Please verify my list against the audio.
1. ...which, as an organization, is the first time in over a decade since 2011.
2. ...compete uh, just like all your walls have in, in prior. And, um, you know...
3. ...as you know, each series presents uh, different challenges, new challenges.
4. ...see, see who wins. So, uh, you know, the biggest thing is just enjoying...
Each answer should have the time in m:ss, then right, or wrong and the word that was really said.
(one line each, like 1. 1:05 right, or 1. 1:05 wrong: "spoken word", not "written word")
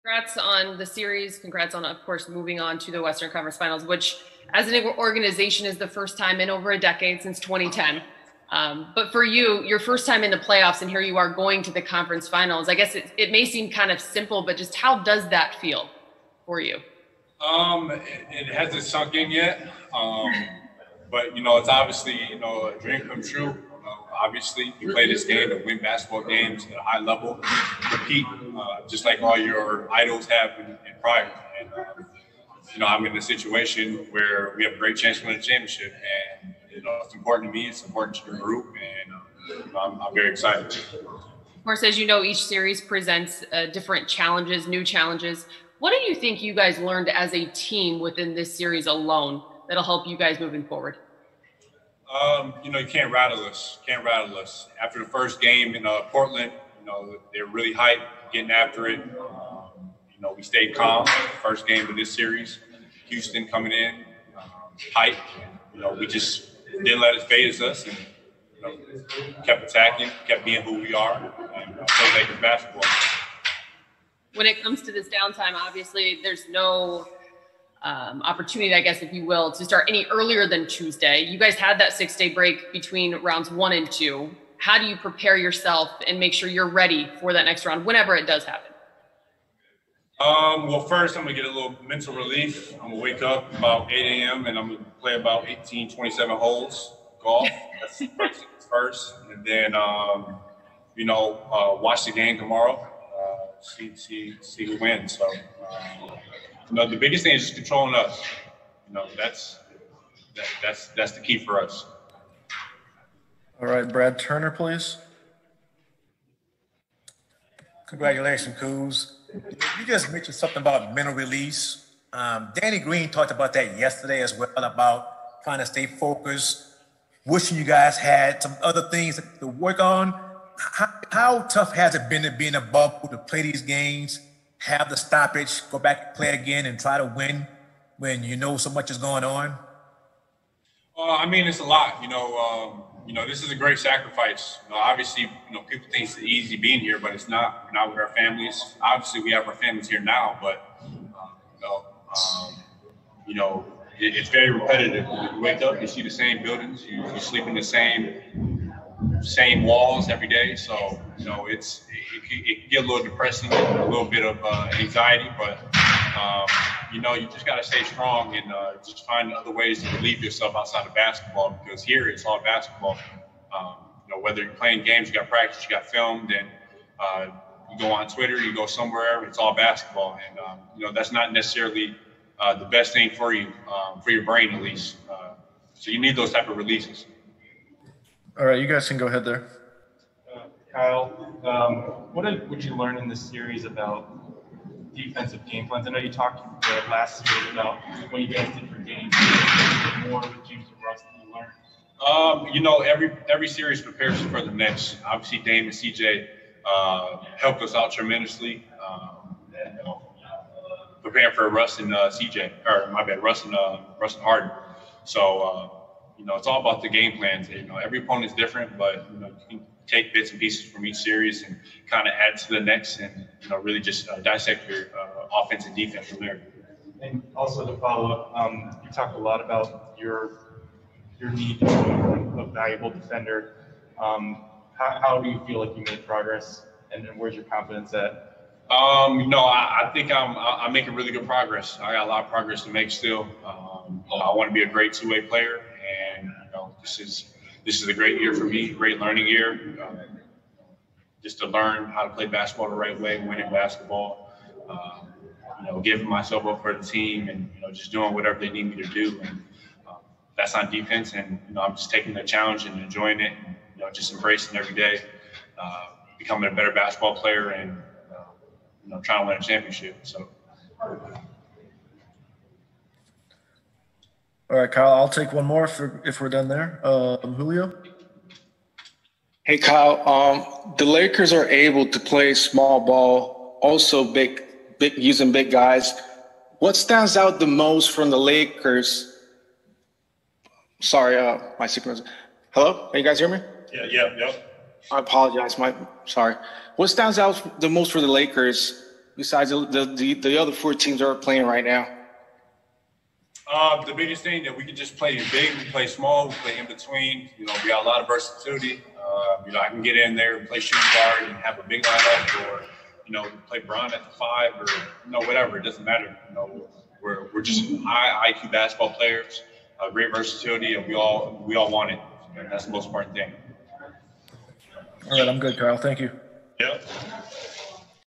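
1. 0:03 wrong: "2010", not "2011"
2. 0:27 wrong: "idols", not "walls"
3. 0:41 right
4. 1:43 wrong: "controlling", not "enjoying".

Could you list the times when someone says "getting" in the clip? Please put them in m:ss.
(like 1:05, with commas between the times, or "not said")
0:58.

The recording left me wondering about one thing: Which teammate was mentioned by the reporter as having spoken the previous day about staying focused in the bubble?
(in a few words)
Danny Green.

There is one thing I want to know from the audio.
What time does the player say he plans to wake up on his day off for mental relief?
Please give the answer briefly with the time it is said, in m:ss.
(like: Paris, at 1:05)
8 a.m., at 1:33.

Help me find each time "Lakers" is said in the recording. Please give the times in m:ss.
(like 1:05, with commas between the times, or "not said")
1:12, 4:40, 4:48, 4:58.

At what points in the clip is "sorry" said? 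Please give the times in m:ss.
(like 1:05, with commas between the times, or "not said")
4:50, 4:56.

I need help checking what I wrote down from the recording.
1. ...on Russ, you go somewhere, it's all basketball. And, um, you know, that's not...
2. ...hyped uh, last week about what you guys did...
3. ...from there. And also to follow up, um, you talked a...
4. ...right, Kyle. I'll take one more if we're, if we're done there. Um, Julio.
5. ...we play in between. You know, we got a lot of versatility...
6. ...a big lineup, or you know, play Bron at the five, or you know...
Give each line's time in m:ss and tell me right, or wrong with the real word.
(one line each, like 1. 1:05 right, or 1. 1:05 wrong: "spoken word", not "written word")
1. 2:57 wrong: "Twitter", not "Russ"
2. 3:16 wrong: "talked", not "hyped"
3. 3:46 right
4. 4:34 right
5. 5:06 right
6. 5:11 right.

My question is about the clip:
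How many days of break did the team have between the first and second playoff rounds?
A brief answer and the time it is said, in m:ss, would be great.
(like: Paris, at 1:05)
6 days, at 1:21.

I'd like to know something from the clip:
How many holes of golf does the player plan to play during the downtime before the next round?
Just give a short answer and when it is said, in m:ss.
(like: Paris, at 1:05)
18, 27, at 1:35.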